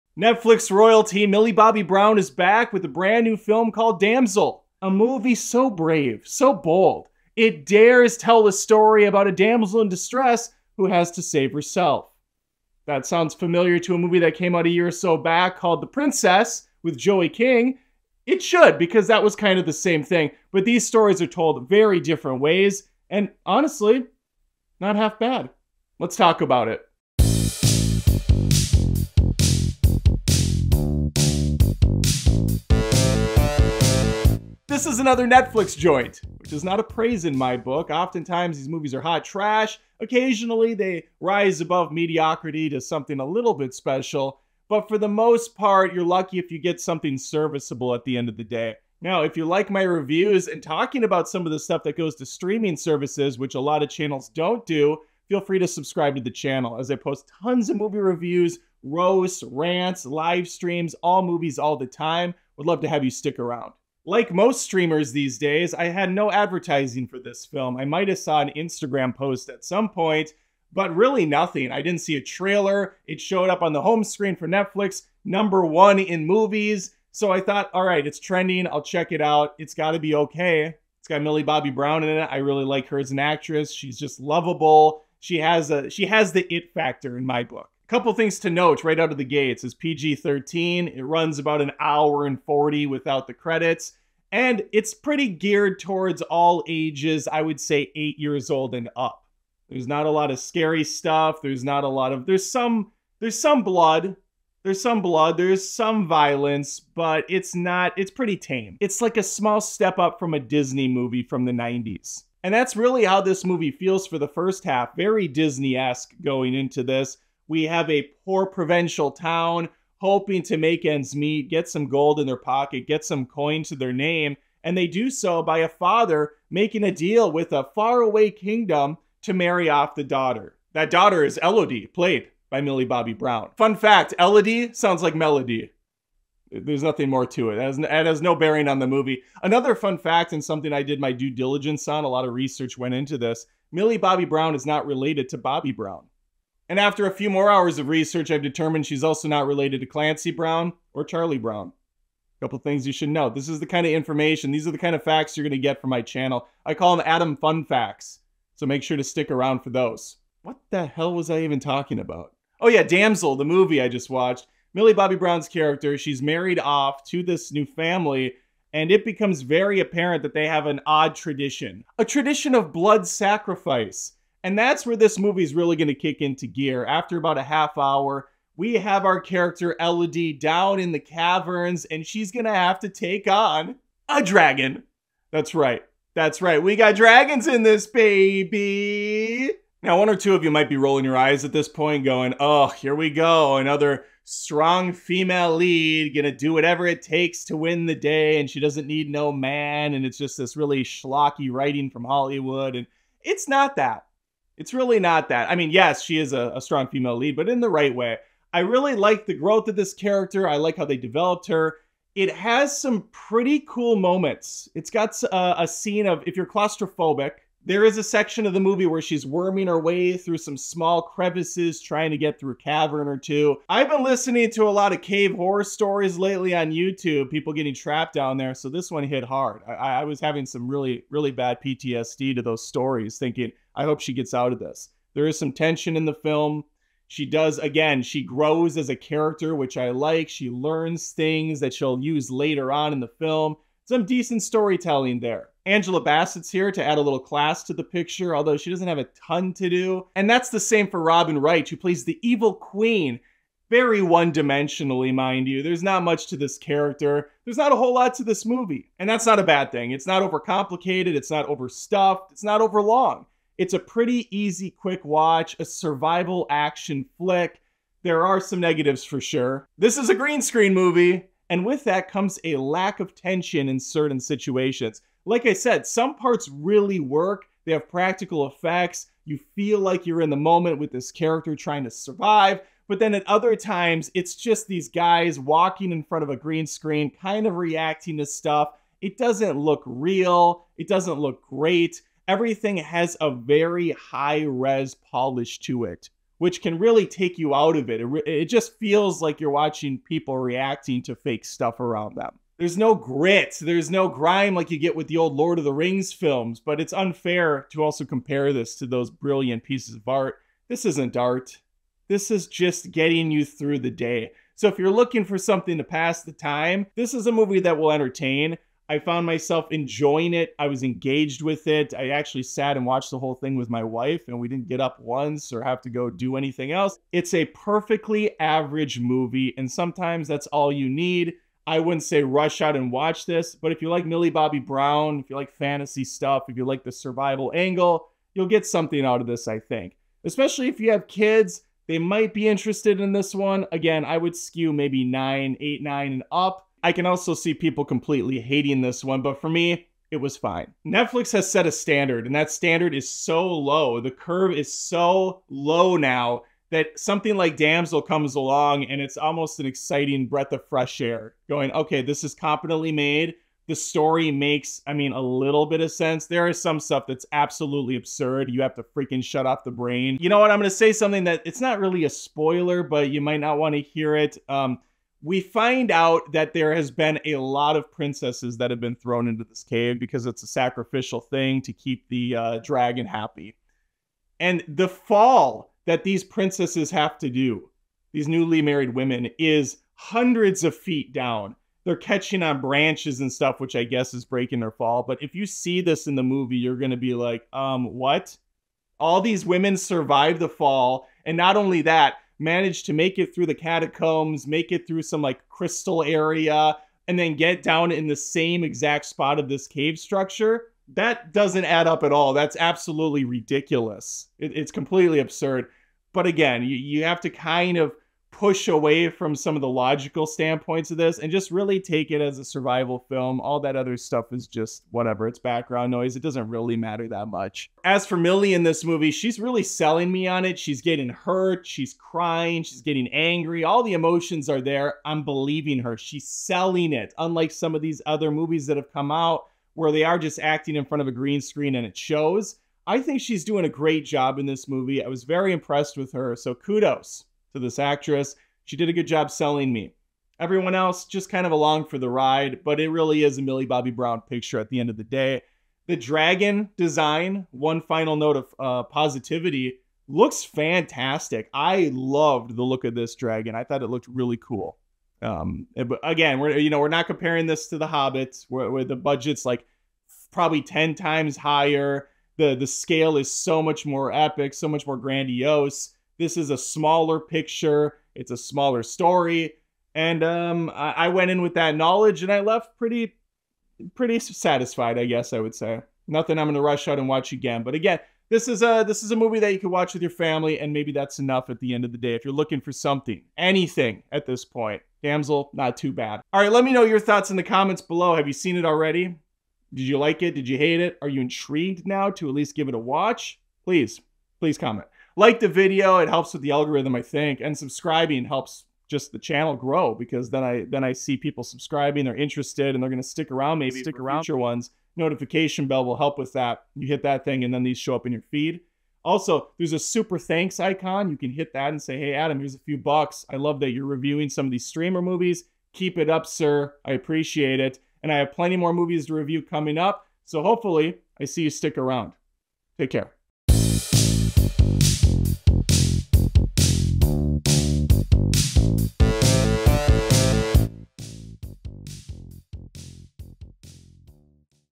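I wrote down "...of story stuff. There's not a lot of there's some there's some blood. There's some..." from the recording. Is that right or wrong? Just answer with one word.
wrong.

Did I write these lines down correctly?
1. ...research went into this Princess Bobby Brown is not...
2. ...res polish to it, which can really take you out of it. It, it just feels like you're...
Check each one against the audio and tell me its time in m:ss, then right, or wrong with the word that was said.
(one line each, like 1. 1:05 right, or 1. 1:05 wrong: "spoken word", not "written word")
1. 2:22 wrong: "Millie", not "Princess"
2. 4:54 right.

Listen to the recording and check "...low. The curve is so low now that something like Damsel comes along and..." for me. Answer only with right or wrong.
right.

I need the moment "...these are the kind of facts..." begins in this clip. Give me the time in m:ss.
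2:34.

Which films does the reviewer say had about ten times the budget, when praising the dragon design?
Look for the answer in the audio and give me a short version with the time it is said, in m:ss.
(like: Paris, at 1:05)
The Hobbits, at 7:47.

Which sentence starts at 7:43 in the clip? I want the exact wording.
I thought it looked really cool.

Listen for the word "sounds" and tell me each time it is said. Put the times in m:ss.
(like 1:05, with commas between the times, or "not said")
0:13, 2:14.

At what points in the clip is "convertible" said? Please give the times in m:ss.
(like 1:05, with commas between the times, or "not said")
not said.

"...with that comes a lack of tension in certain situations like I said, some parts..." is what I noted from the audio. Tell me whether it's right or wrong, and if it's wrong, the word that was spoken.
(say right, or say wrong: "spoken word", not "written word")
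right.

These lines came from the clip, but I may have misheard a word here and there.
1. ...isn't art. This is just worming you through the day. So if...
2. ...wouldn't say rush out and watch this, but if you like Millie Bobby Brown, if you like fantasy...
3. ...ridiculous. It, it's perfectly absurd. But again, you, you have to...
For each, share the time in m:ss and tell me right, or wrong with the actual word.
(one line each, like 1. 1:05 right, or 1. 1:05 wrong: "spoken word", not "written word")
1. 5:10 wrong: "getting", not "worming"
2. 5:31 right
3. 6:53 wrong: "completely", not "perfectly".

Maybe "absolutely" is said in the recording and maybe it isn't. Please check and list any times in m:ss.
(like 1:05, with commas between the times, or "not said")
6:07, 6:52.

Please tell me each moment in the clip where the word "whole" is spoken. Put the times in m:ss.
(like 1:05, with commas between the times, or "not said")
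4:17, 5:23.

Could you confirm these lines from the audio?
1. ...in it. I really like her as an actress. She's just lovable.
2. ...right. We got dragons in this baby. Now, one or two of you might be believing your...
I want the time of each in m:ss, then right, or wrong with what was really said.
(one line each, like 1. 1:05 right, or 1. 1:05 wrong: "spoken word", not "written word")
1. 1:22 right
2. 3:06 wrong: "rolling", not "believing".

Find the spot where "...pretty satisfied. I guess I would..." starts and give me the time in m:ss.
8:03.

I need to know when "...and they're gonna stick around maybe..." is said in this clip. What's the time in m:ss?
8:32.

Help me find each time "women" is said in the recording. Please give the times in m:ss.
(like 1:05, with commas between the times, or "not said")
6:28, 6:39.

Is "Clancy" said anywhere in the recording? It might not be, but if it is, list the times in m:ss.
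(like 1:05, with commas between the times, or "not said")
2:29.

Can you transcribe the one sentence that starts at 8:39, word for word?
Also, there's a super thanks icon.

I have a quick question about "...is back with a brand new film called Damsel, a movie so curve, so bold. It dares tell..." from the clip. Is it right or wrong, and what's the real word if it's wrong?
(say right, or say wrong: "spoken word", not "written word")
wrong: "brave", not "curve".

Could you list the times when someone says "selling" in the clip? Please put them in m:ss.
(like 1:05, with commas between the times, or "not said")
7:09, 7:16, 7:29.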